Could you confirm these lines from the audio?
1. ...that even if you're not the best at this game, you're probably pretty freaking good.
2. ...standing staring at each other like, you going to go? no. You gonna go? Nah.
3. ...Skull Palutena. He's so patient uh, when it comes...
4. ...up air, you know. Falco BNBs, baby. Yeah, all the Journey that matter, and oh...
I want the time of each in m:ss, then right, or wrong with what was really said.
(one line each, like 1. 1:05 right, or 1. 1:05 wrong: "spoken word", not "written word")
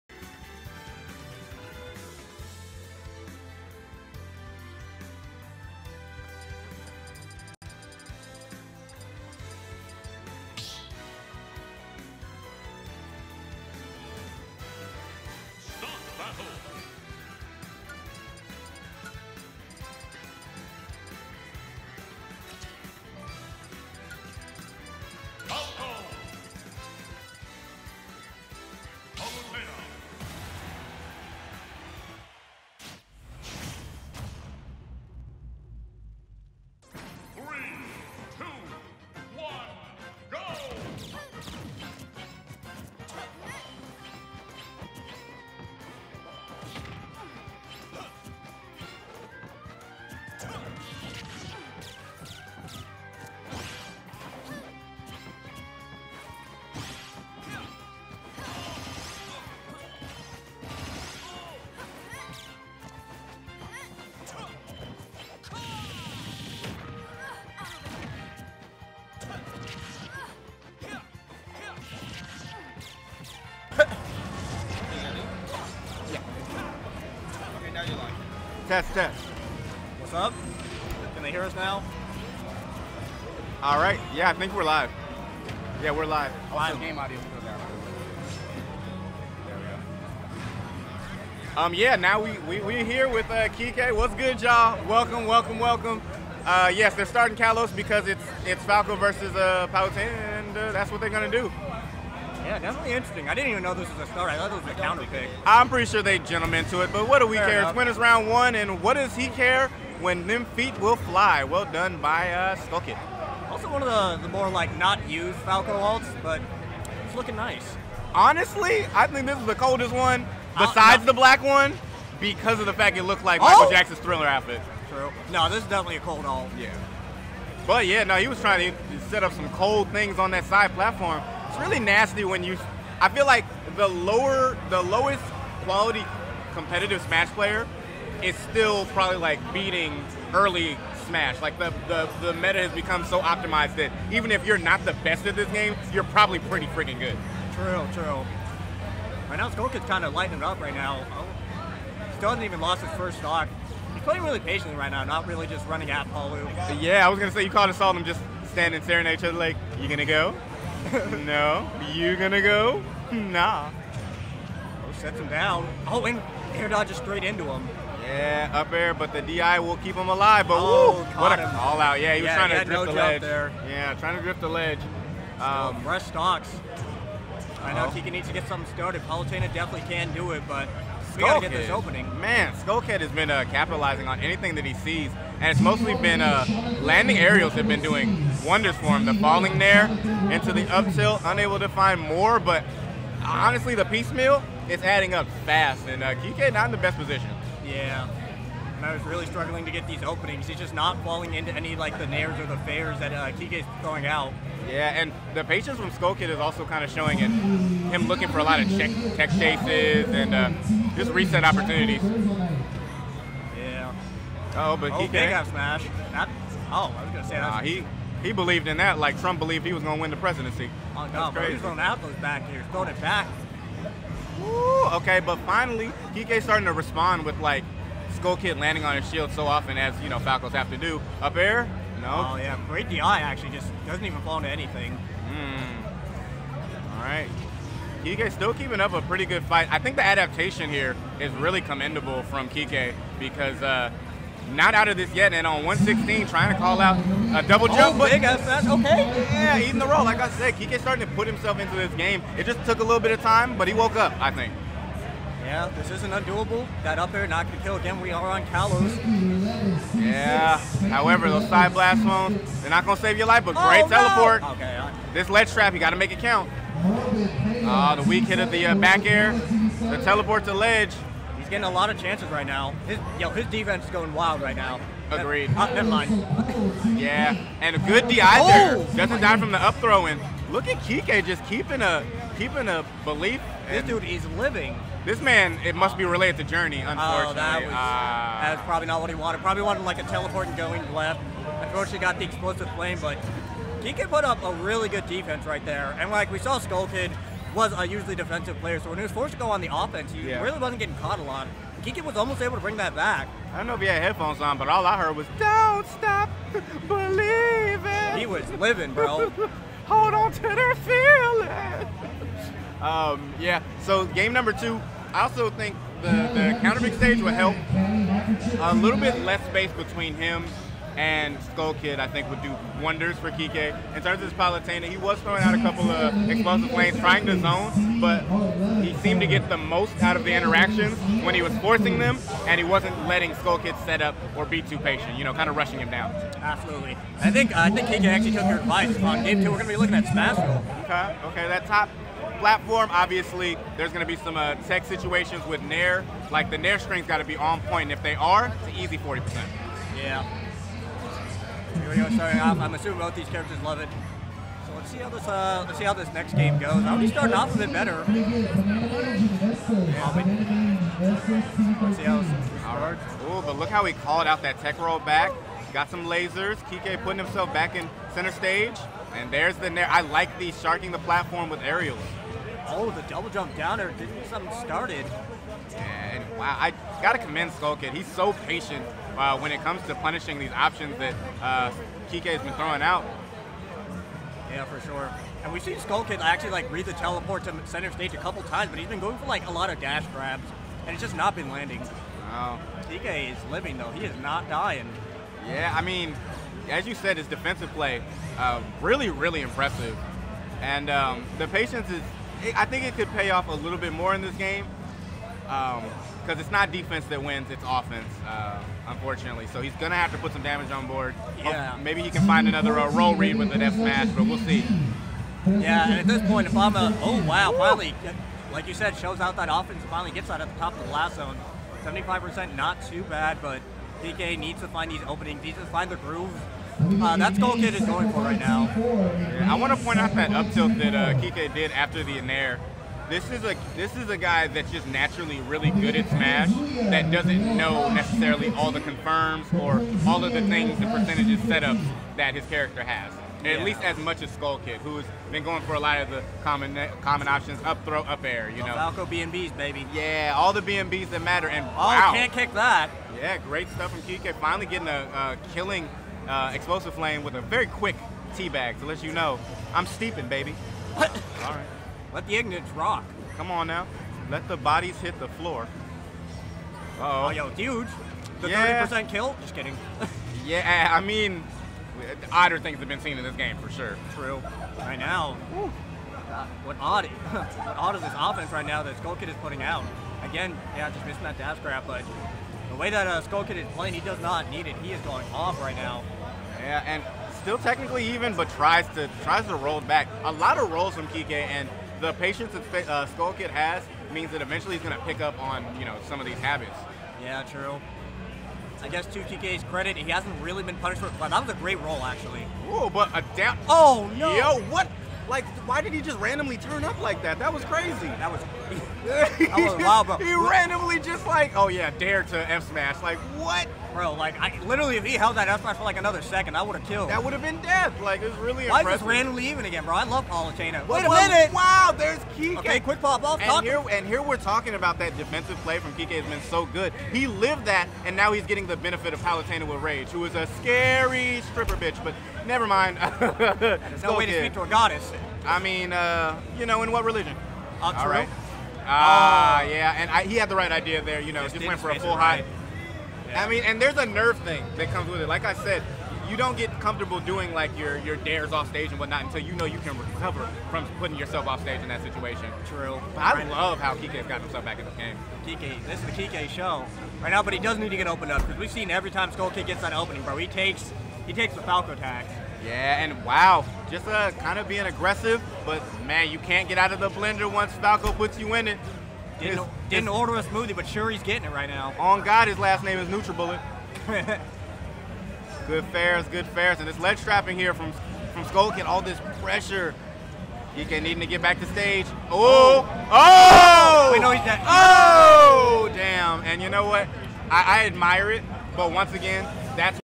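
1. 2:23 right
2. 2:38 right
3. 6:17 wrong: "Kid", not "Palutena"
4. 7:28 wrong: "BNBs", not "Journey".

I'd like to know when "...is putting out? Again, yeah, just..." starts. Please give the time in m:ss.
7:59.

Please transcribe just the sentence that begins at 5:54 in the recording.
So let's see how this uh, let's see how this next game goes.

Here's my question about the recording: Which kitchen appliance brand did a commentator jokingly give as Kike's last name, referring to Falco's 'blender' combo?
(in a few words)
NutriBullet.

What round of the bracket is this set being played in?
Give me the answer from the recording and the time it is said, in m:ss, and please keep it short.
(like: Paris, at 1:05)
Winners round one, at 1:47.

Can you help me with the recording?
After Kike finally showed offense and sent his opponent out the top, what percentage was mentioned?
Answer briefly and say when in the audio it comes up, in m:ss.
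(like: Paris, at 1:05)
75%, at 7:01.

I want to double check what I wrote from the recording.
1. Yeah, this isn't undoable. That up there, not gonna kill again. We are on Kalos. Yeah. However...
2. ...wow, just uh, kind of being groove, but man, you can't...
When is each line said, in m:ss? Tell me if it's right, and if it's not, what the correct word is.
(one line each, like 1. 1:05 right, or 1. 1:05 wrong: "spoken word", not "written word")
1. 4:15 right
2. 9:23 wrong: "aggressive", not "groove".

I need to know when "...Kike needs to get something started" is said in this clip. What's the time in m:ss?
2:57.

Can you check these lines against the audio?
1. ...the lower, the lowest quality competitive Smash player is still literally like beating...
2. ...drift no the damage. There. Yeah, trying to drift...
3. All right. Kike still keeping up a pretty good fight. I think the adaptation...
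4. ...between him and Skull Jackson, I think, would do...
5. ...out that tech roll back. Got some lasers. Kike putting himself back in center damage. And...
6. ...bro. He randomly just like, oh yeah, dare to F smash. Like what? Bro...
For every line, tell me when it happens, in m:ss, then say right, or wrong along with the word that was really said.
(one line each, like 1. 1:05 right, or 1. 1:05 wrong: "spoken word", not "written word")
1. 2:13 wrong: "probably", not "literally"
2. 2:52 wrong: "ledge", not "damage"
3. 3:56 right
4. 5:19 wrong: "Kid", not "Jackson"
5. 6:04 wrong: "stage", not "damage"
6. 8:30 right.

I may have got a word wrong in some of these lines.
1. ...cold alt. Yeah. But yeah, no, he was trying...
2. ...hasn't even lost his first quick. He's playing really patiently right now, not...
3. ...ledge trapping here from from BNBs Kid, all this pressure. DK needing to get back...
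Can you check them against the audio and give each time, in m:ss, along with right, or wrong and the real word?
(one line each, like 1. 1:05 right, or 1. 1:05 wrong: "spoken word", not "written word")
1. 2:06 right
2. 2:32 wrong: "stock", not "quick"
3. 9:36 wrong: "Skull", not "BNBs".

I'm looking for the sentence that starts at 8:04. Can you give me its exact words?
He is going off right now.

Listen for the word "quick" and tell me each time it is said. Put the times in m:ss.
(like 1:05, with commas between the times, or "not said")
7:37, 8:42.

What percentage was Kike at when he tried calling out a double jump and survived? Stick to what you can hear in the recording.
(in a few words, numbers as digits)
116.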